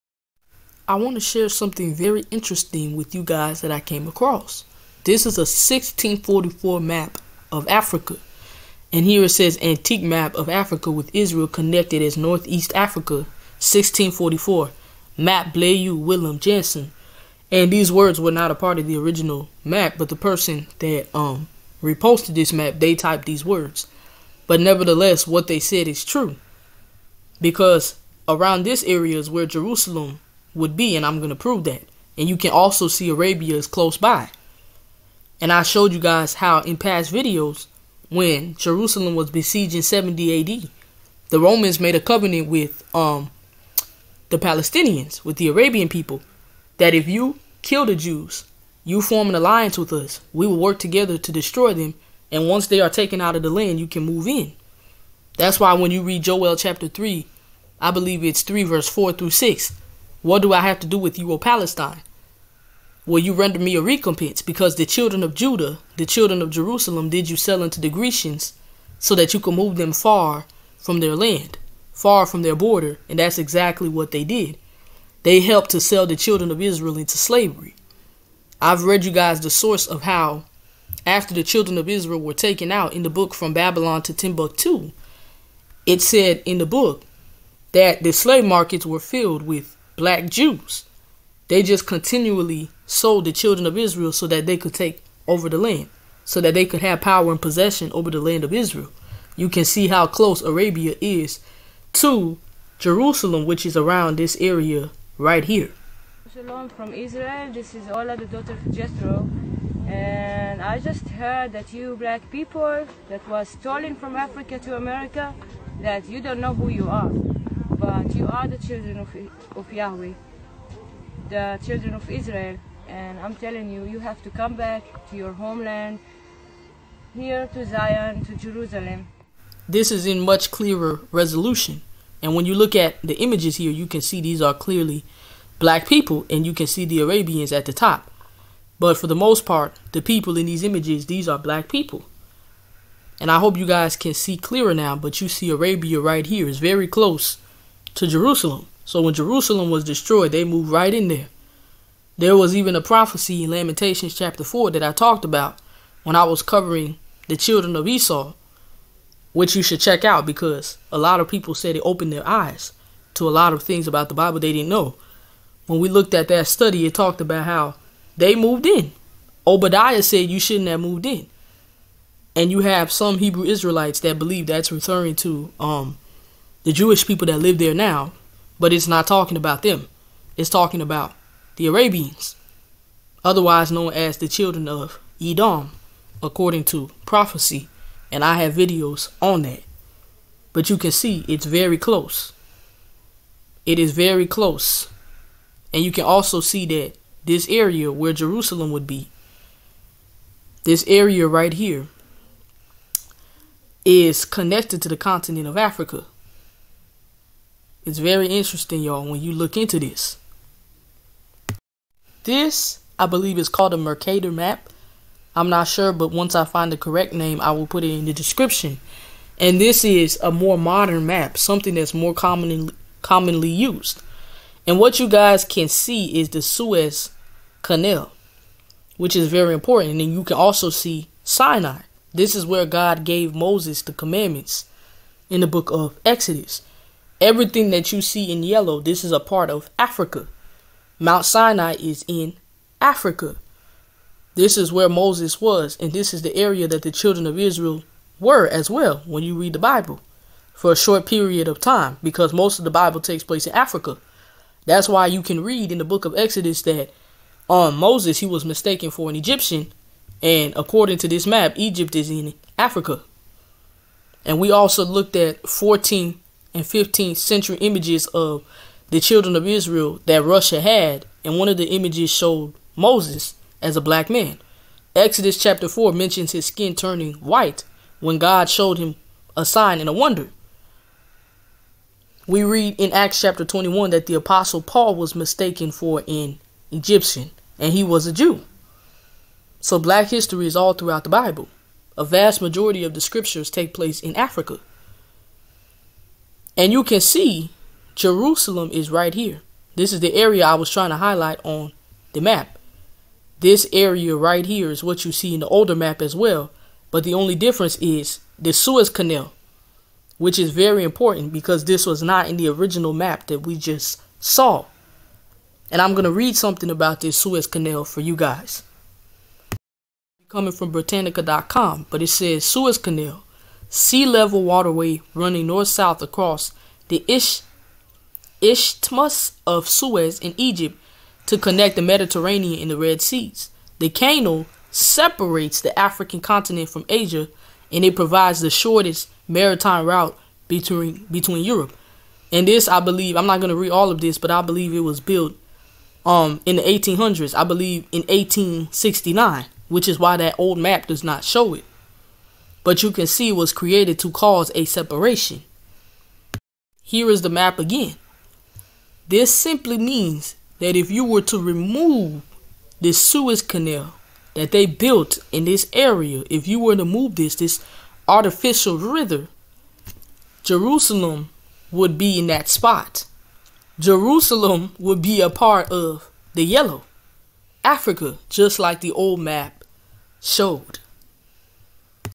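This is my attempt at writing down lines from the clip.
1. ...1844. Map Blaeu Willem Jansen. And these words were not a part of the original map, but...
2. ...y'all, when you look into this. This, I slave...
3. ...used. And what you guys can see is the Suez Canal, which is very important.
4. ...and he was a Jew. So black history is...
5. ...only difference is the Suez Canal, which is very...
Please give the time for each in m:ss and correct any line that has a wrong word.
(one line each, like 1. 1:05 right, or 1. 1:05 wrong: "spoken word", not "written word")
1. 0:13 wrong: "1644", not "1844"
2. 3:28 wrong: "believe", not "slave"
3. 3:43 right
4. 4:47 right
5. 5:07 right.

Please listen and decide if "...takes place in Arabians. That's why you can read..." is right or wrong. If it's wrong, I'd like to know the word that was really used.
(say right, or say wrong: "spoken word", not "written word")
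wrong: "Africa", not "Arabians".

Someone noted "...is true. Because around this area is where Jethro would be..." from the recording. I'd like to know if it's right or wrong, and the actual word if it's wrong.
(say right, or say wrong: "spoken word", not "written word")
wrong: "Jerusalem", not "Jethro".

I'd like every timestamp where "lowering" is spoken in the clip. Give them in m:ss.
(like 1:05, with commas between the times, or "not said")
not said.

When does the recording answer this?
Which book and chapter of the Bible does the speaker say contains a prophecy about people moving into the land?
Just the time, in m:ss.
2:33.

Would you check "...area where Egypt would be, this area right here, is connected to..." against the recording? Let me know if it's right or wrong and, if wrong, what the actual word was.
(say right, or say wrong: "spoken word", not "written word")
wrong: "Jerusalem", not "Egypt".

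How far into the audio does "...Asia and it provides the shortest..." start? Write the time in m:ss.
5:36.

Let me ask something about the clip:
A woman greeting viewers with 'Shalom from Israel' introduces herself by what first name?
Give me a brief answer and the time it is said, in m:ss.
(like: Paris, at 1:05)
Ola, at 1:47.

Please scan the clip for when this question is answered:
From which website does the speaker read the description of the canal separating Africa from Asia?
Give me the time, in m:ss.
5:20.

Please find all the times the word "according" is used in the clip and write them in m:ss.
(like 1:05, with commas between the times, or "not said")
3:06, 4:20.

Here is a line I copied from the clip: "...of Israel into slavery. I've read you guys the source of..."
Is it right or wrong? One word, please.
right.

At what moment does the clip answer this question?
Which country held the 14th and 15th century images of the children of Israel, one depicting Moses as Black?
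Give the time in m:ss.
4:30.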